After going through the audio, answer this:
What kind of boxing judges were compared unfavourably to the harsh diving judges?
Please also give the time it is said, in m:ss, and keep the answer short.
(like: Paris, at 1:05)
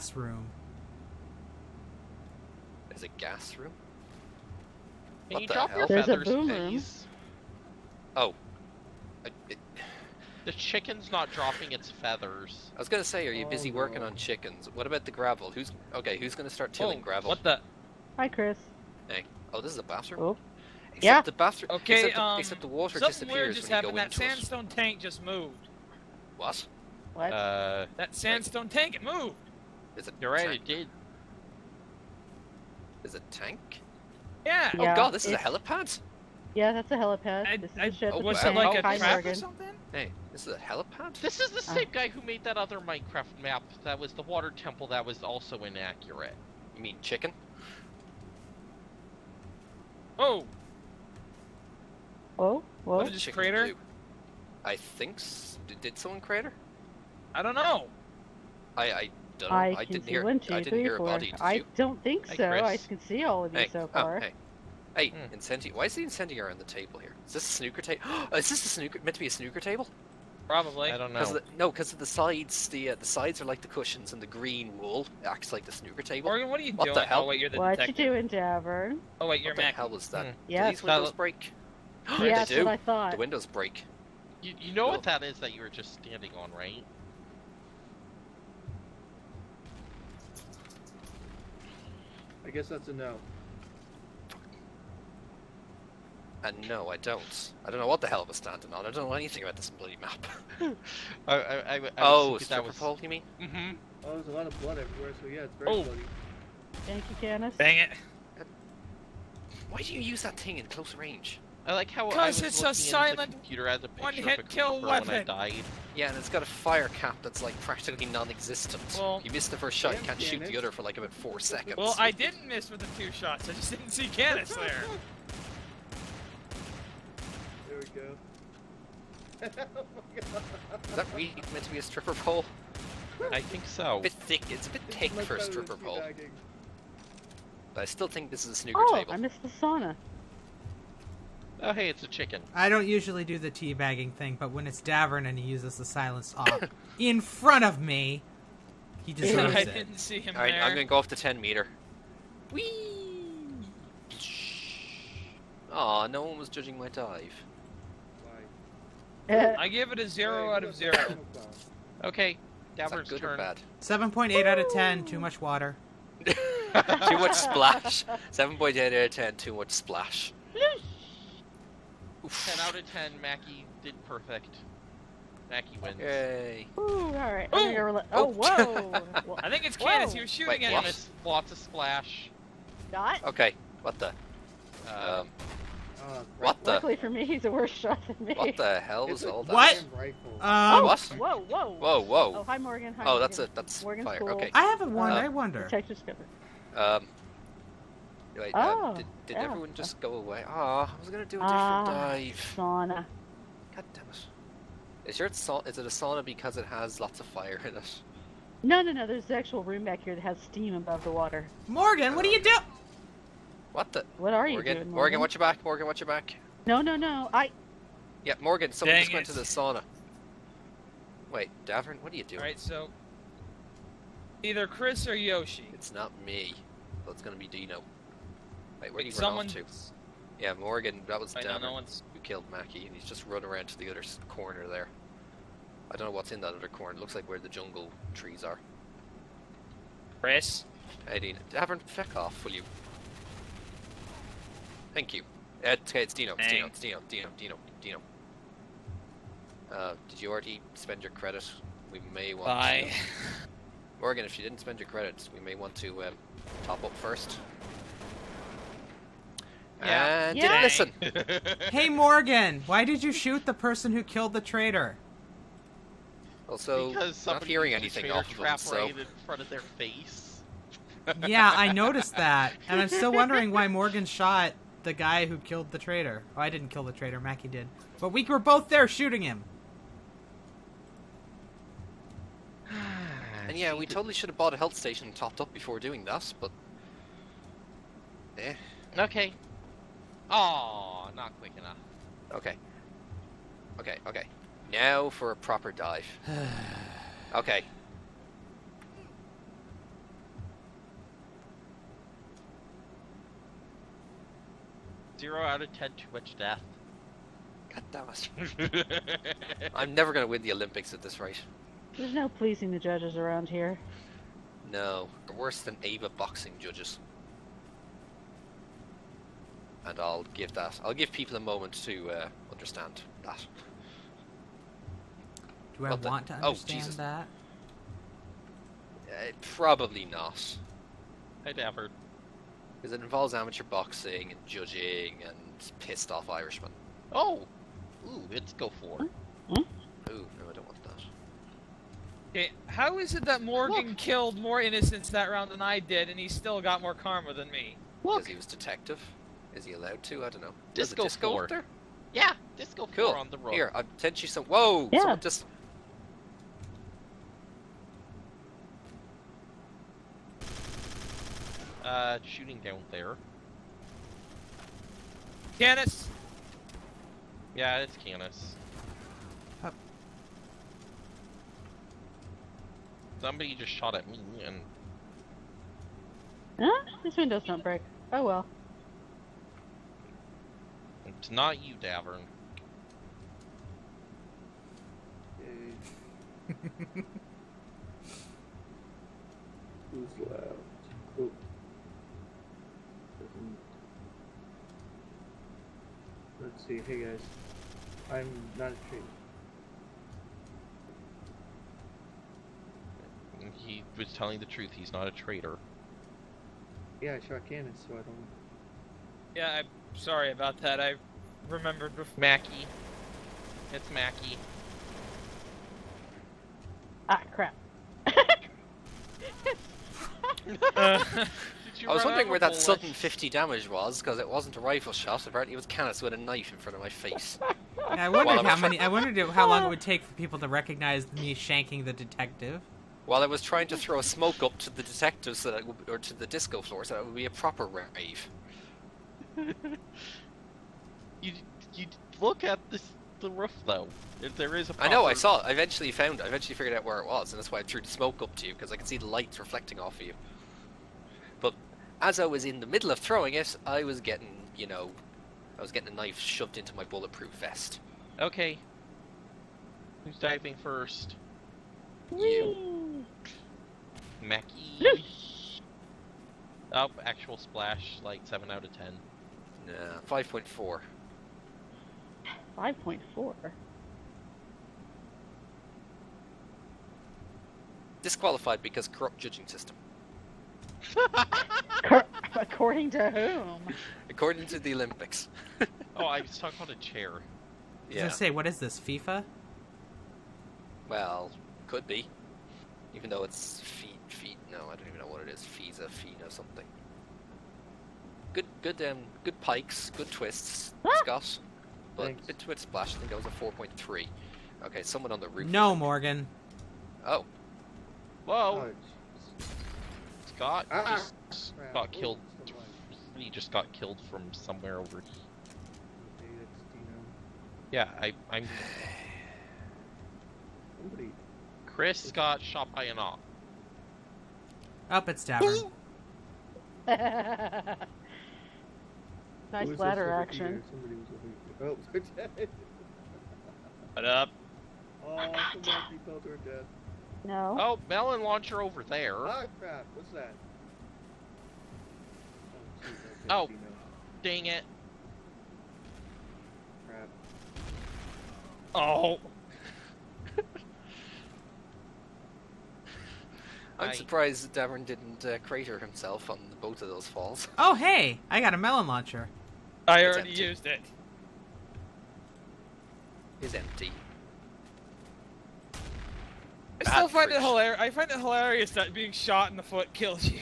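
Ava boxing judges, at 5:15.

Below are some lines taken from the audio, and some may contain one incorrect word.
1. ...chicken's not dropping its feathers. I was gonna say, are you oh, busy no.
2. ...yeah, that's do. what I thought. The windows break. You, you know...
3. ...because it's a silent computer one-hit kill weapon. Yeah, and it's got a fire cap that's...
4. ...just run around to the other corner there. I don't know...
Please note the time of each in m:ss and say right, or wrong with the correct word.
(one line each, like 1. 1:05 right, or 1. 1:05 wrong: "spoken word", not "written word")
1. 0:10 right
2. 1:22 right
3. 1:52 right
4. 3:53 right.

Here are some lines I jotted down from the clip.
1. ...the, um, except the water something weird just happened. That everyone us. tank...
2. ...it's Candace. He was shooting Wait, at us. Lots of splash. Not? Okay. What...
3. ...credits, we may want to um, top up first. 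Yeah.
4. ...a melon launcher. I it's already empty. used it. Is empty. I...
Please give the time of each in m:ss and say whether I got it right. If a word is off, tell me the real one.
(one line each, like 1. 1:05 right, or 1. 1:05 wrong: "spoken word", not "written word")
1. 0:22 wrong: "sandstone", not "everyone"
2. 2:59 right
3. 4:14 right
4. 9:18 right.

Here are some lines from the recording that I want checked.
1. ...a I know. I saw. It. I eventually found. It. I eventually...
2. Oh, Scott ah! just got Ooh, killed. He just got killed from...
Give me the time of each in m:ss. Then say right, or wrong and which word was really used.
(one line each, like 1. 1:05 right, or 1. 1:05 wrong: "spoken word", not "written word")
1. 7:24 right
2. 8:28 right.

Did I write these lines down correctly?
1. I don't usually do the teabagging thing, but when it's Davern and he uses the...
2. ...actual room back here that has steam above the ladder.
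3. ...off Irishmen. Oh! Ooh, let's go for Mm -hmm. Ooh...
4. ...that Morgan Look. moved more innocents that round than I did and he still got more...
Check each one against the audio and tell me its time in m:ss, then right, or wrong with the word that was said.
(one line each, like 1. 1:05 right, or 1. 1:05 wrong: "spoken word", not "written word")
1. 2:22 right
2. 3:29 wrong: "water", not "ladder"
3. 5:36 right
4. 5:43 wrong: "killed", not "moved".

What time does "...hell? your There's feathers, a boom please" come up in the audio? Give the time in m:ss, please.
0:05.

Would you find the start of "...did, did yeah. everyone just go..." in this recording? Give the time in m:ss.
3:18.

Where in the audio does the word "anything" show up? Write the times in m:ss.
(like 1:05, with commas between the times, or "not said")
1:39, 4:27.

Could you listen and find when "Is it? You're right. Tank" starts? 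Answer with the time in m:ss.
0:29.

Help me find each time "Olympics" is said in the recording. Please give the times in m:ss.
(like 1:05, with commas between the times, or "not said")
5:10, 8:04.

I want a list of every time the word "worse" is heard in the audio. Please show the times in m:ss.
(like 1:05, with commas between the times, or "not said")
3:07, 5:15.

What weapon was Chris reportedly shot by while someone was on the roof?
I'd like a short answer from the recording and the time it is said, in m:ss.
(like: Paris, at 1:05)
AUG, at 8:42.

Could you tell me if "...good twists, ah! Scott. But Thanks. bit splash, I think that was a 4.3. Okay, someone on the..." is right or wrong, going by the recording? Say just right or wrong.
right.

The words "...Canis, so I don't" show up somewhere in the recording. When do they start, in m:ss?
6:47.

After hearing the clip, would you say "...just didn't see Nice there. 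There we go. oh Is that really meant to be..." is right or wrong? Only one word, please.
wrong.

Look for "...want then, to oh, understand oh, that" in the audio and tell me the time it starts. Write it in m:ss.
5:25.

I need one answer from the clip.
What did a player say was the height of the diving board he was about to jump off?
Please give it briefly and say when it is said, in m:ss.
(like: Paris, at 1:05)
10 meter, at 2:31.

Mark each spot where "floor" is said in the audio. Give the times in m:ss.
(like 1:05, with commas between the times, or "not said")
7:16.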